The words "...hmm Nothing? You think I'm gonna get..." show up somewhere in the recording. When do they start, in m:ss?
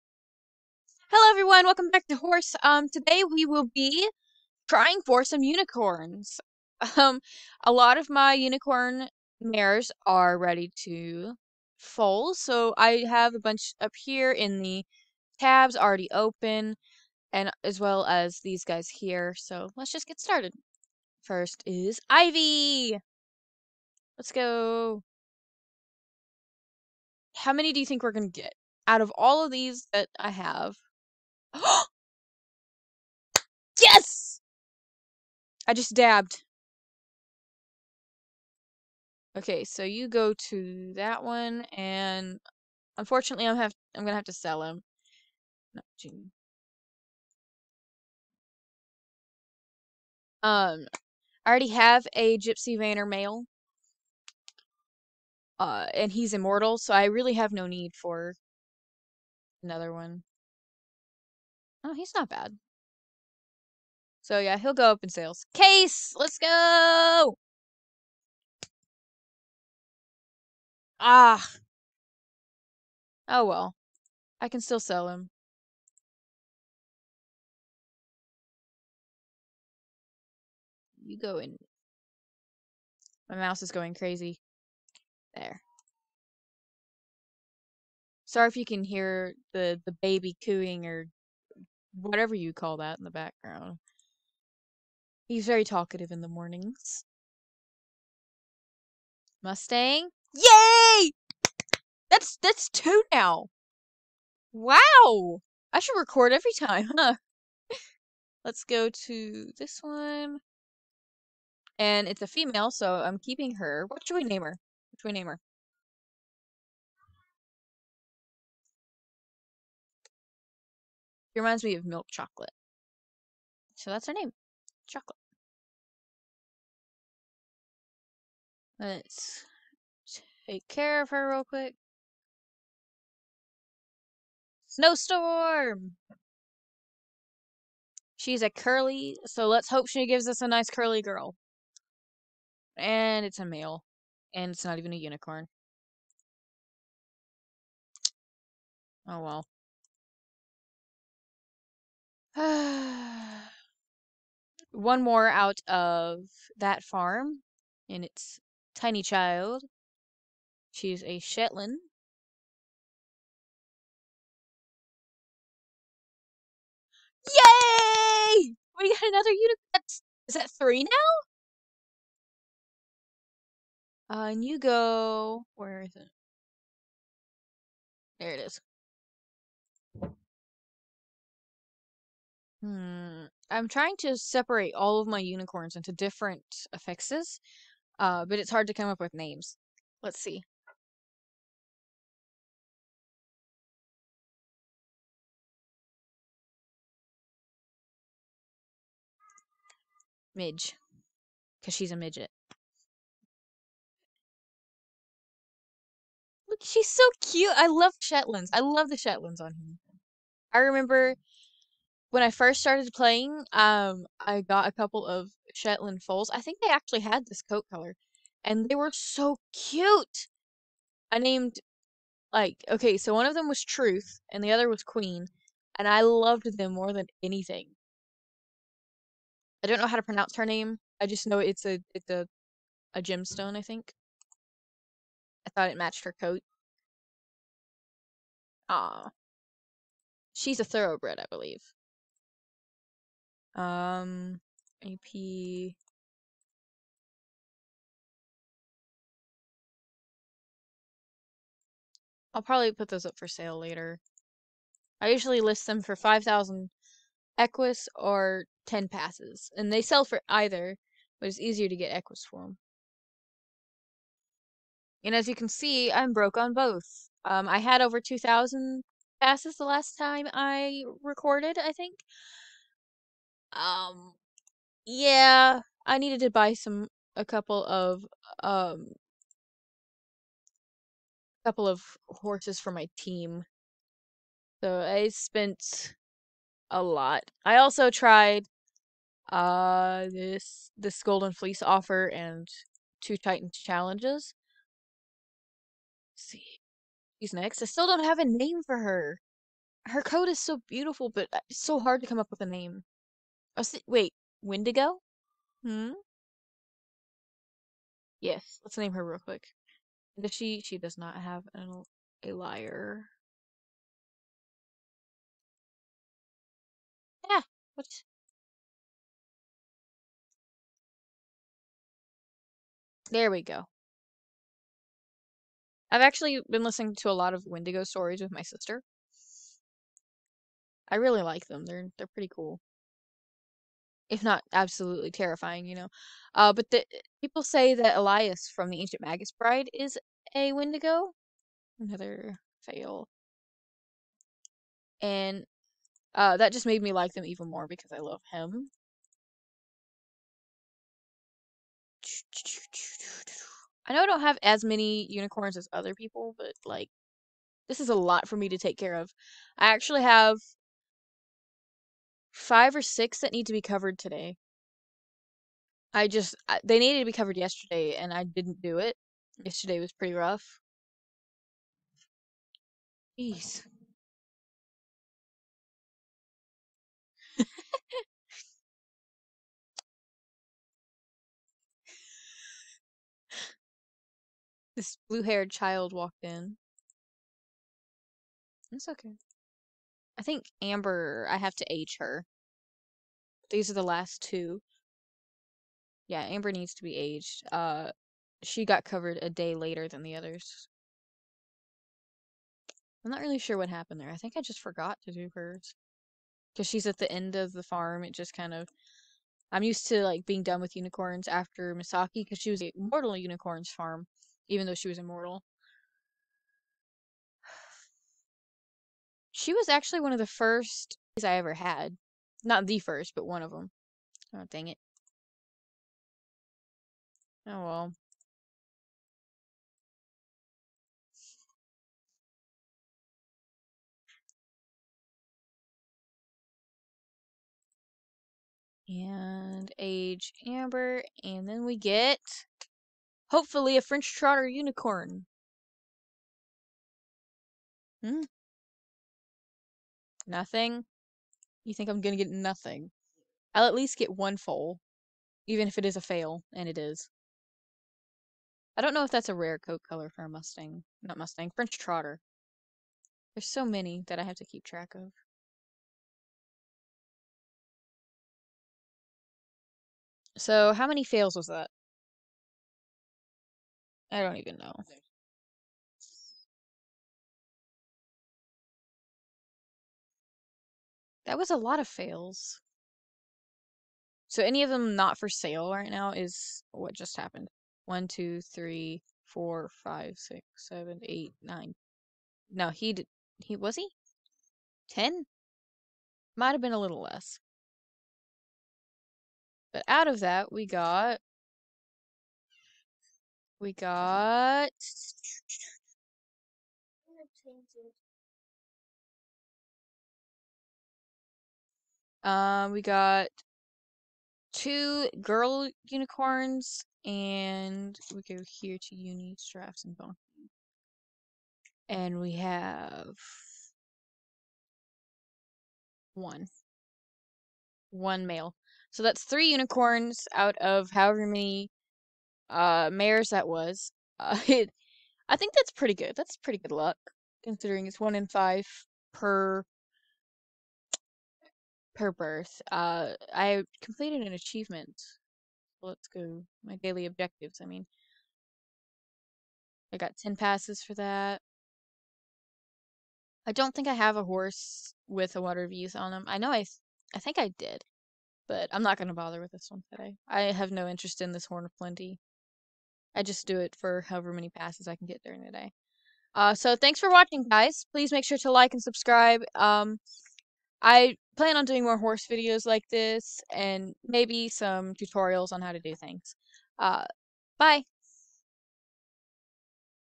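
7:28.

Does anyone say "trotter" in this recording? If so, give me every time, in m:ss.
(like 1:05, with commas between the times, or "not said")
7:24, 7:41.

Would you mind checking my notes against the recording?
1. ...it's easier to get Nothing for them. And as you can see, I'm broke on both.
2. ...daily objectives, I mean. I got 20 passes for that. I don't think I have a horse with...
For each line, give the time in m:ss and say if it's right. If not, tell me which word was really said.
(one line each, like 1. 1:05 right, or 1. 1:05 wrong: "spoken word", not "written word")
1. 4:21 wrong: "Equus", not "Nothing"
2. 9:06 wrong: "10", not "20".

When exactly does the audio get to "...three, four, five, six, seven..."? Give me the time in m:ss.
8:08.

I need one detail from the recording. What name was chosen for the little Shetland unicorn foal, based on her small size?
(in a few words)
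Midge.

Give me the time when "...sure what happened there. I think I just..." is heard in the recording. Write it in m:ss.
6:43.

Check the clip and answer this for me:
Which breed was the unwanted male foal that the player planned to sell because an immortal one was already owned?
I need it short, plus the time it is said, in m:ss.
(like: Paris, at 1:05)
Gypsy Vanner, at 0:52.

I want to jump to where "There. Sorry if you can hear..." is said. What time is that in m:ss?
1:25.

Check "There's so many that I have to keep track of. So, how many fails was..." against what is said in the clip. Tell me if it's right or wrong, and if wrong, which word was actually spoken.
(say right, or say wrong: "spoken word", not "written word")
right.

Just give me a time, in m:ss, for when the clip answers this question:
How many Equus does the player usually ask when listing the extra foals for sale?
4:15.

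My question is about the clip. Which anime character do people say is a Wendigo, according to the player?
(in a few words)
Elias.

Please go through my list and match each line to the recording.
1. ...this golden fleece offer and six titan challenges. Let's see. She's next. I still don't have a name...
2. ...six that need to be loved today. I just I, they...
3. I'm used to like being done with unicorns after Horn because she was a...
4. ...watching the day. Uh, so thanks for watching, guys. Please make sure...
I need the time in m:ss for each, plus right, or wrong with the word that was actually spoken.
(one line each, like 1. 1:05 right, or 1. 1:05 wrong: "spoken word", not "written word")
1. 4:50 wrong: "two", not "six"
2. 6:02 wrong: "covered", not "loved"
3. 6:49 wrong: "Misaki", not "Horn"
4. 9:25 wrong: "during", not "watching".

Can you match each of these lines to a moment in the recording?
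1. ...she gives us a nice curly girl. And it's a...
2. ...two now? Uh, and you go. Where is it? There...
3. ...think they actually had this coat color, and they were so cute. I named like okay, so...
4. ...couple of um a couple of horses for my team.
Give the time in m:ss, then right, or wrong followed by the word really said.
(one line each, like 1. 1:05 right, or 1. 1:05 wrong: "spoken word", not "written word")
1. 2:19 right
2. 2:50 wrong: "three", not "two"
3. 3:36 right
4. 4:37 right.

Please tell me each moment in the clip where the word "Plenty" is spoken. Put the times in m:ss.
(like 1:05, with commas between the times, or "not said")
9:21.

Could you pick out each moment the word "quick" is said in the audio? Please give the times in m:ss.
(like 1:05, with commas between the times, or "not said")
2:11, 5:09.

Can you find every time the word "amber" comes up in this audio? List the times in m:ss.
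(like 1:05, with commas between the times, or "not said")
6:30, 6:36, 7:20.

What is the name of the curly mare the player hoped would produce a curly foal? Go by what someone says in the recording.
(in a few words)
Snowstorm.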